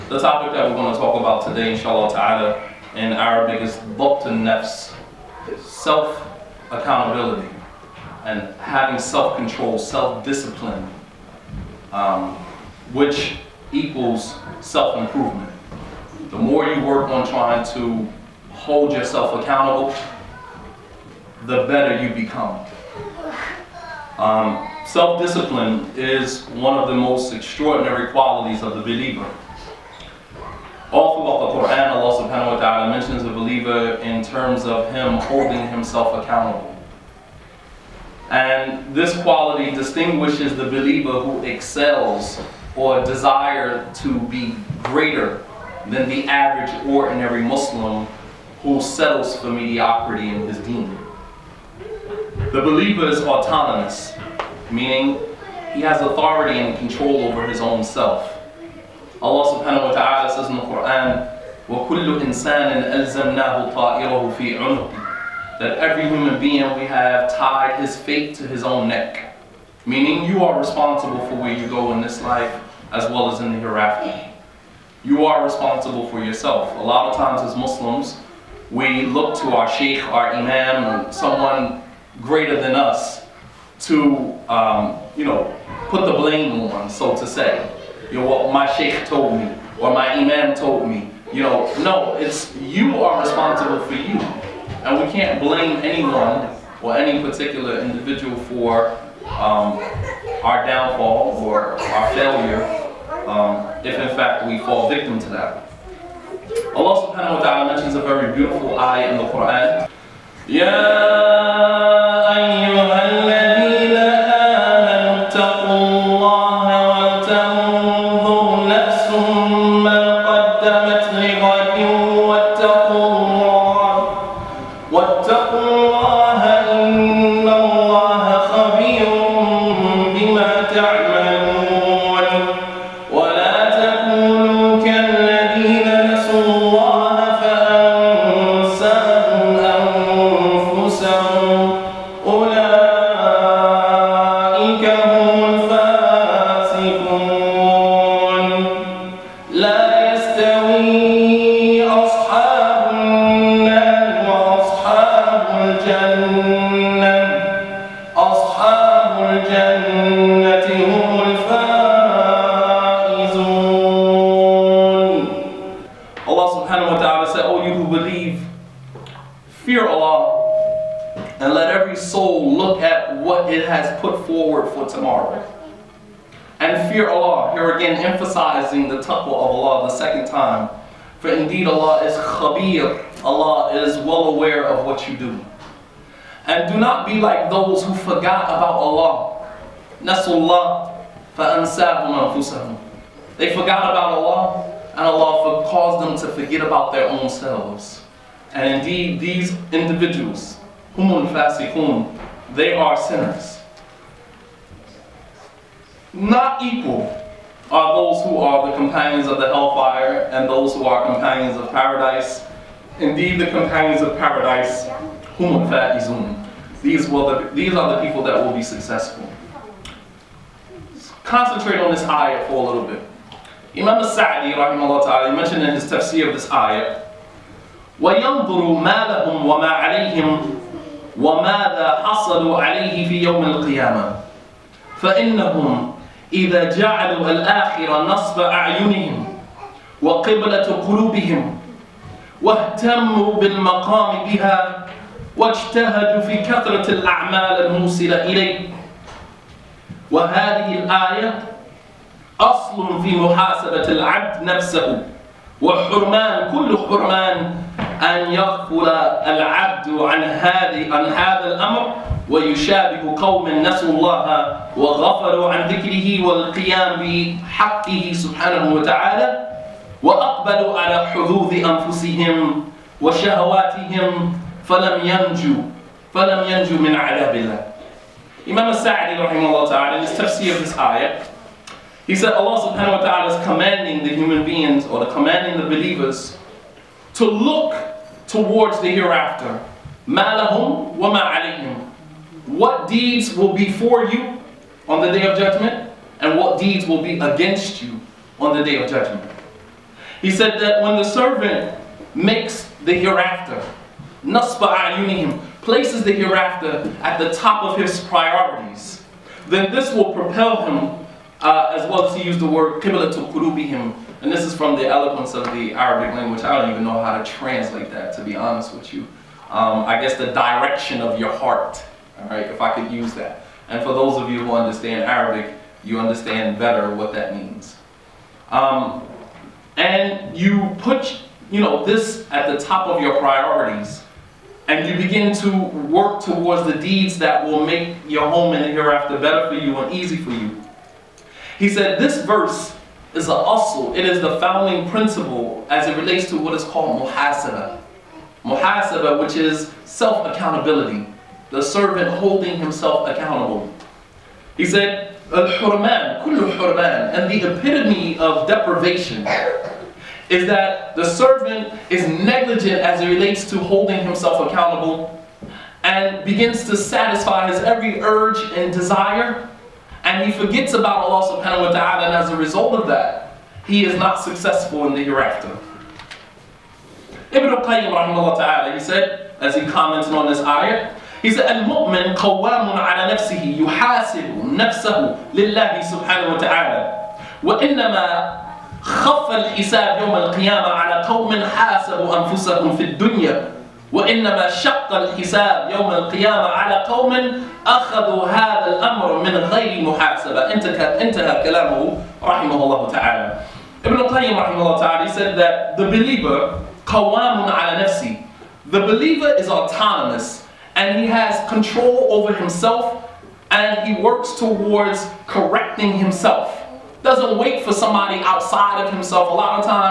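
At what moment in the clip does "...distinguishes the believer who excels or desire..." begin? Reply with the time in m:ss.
0:39.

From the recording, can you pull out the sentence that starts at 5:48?
Muhasabah, which is self-accountability, the servant holding himself accountable.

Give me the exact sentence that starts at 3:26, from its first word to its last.
Not equal are those who are the companions of the hellfire and those who are companions of paradise.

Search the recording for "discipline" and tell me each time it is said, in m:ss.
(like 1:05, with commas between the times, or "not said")
0:10, 0:24.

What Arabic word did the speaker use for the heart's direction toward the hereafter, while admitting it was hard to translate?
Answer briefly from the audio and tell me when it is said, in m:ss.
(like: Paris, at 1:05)
qiblatul, at 5:12.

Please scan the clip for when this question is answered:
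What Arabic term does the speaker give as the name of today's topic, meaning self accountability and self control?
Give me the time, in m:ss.
0:03.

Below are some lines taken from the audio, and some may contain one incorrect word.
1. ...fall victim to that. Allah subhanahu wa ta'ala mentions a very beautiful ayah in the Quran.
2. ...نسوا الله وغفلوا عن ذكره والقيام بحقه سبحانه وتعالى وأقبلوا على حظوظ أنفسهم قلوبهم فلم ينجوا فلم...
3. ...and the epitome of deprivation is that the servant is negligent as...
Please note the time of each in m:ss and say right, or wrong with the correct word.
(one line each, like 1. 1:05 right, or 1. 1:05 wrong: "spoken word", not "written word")
1. 1:44 right
2. 4:23 wrong: "وشهواتهم", not "قلوبهم"
3. 5:57 right.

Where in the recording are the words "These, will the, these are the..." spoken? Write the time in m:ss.
3:36.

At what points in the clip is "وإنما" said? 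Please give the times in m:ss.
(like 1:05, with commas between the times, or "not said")
6:27, 6:33.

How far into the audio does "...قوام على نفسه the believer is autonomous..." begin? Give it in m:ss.
6:46.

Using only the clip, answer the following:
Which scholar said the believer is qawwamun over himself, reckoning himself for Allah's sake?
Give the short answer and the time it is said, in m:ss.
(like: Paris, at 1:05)
Ibn al-Qayyim, at 6:17.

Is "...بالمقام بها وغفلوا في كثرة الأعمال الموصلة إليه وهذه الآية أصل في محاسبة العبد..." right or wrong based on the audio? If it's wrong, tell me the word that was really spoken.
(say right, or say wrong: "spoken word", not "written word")
wrong: "واجتهدوا", not "وغفلوا".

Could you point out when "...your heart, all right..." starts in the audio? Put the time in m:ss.
5:21.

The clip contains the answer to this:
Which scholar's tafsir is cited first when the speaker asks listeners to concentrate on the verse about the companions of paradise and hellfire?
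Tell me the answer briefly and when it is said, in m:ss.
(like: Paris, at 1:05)
Imam Sadi, at 3:43.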